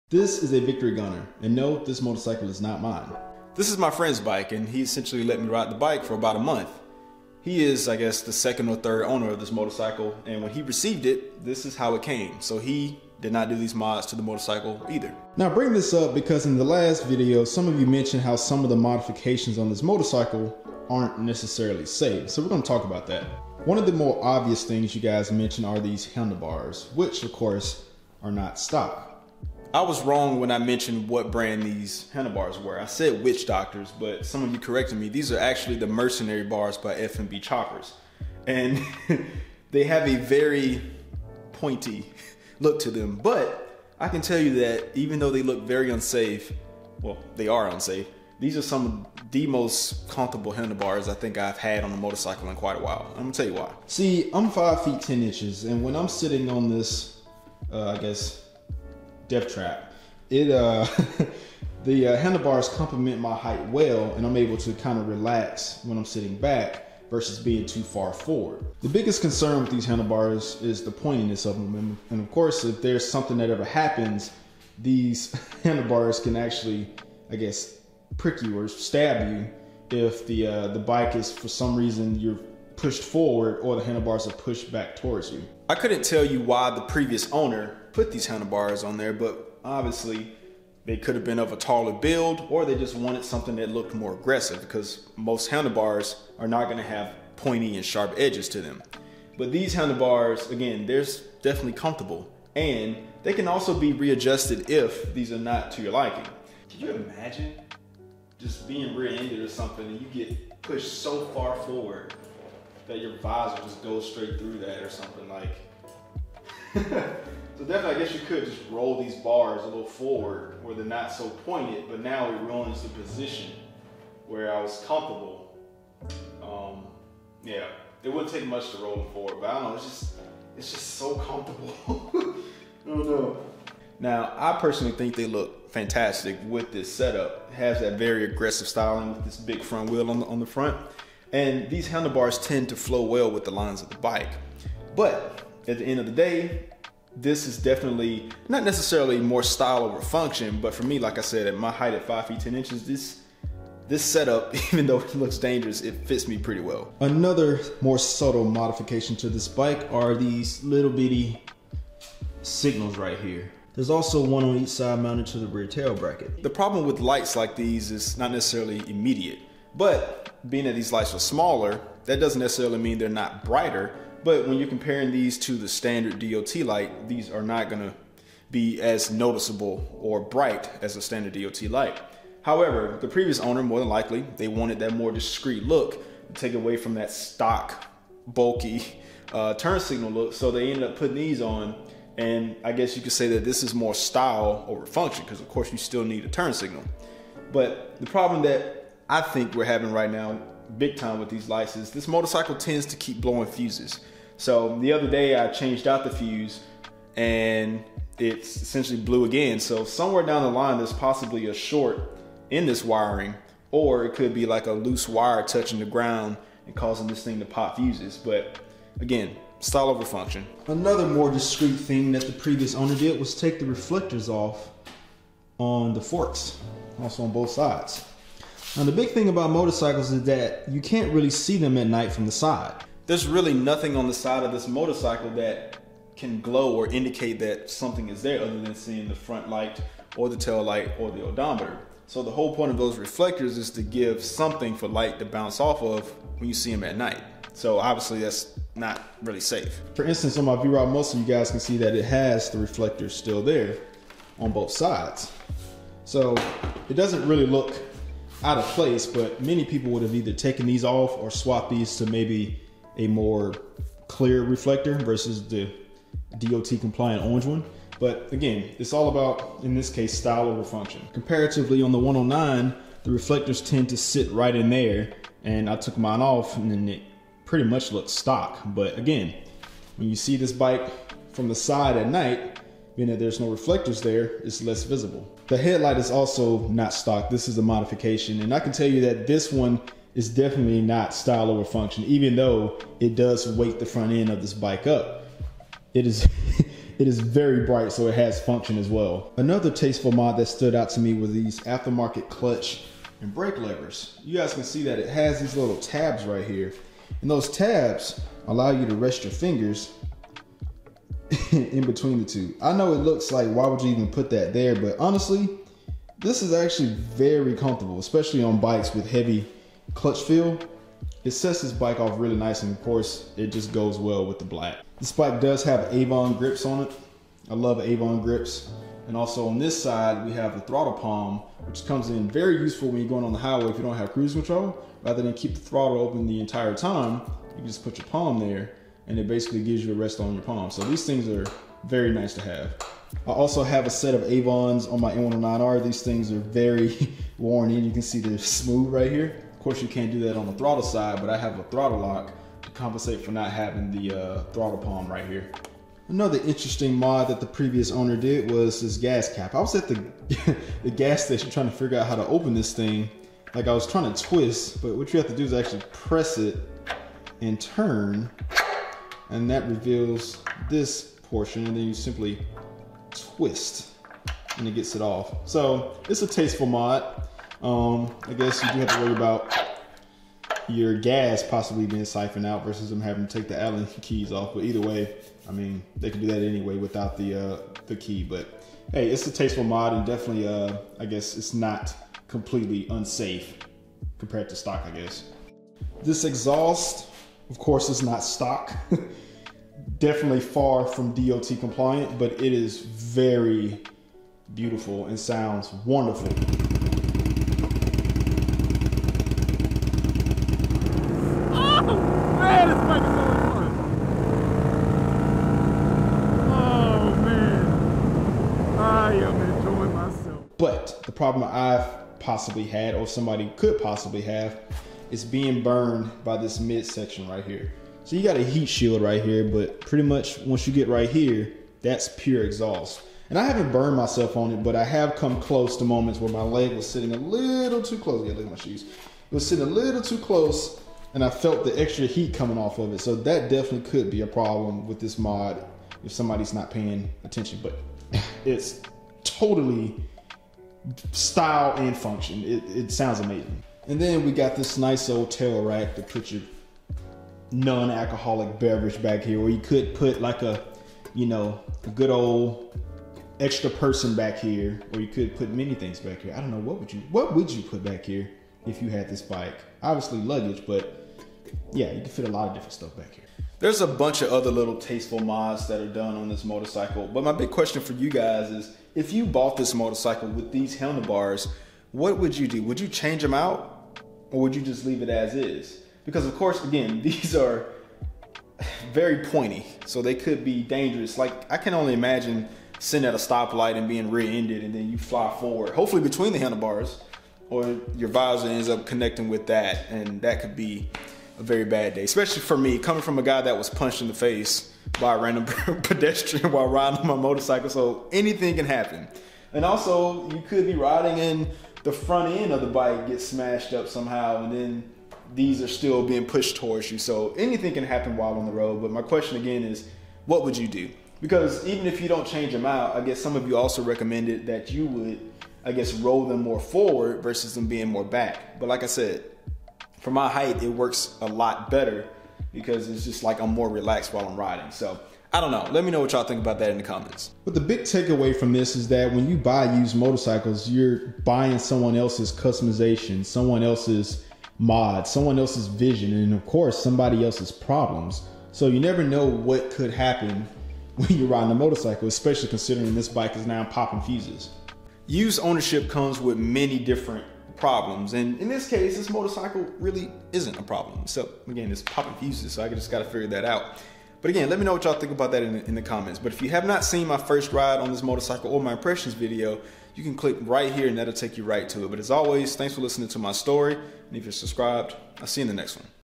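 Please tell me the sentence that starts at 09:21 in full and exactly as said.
So again, it's popping fuses, so I just gotta figure that out.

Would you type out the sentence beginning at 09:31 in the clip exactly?
But as always, thanks for listening to my story.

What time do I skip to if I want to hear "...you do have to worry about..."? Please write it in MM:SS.
06:18.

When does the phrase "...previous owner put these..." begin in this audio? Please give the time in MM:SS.
01:26.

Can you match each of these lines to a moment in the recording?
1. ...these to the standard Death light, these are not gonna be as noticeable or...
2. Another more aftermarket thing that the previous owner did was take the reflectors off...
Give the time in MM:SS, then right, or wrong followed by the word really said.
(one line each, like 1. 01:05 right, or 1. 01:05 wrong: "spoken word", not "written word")
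1. 02:55 wrong: "DOT", not "Death"
2. 03:40 wrong: "discreet", not "aftermarket".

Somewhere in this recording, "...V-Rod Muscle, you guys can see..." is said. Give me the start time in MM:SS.
04:10.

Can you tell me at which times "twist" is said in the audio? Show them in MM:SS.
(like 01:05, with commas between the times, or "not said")
06:04, 06:13.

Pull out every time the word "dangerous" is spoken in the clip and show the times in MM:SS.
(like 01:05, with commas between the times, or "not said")
02:35, 08:10.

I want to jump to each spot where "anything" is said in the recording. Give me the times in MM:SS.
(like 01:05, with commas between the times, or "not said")
08:28, 08:37.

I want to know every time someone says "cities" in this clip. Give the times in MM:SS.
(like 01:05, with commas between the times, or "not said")
not said.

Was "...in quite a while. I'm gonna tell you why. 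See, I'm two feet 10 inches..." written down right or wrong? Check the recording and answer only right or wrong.
wrong.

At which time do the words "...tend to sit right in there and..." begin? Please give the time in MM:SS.
04:33.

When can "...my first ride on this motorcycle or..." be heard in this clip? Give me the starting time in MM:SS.
09:27.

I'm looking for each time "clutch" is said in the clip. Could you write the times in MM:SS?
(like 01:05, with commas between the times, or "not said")
05:02, 05:19.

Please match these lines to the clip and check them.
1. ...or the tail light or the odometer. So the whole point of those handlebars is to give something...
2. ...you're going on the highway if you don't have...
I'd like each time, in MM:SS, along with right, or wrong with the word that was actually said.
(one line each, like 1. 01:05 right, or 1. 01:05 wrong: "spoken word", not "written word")
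1. 04:00 wrong: "reflectors", not "handlebars"
2. 05:33 right.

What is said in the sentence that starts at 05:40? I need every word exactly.
So these things are very nice to have.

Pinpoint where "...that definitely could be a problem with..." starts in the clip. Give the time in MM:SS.
07:23.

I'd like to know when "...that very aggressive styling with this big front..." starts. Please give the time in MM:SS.
02:17.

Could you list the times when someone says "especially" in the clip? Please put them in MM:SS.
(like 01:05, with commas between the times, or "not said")
05:17, 08:22, 09:12.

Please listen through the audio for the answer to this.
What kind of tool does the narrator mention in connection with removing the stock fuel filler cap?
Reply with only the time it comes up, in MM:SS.
06:23.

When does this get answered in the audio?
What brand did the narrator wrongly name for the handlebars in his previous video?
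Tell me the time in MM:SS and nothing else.
00:33.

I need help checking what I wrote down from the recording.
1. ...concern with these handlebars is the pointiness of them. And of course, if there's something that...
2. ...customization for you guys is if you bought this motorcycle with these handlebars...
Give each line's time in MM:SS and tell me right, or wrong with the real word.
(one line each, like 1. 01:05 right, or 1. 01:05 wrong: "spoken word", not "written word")
1. 01:09 right
2. 07:57 wrong: "question", not "customization".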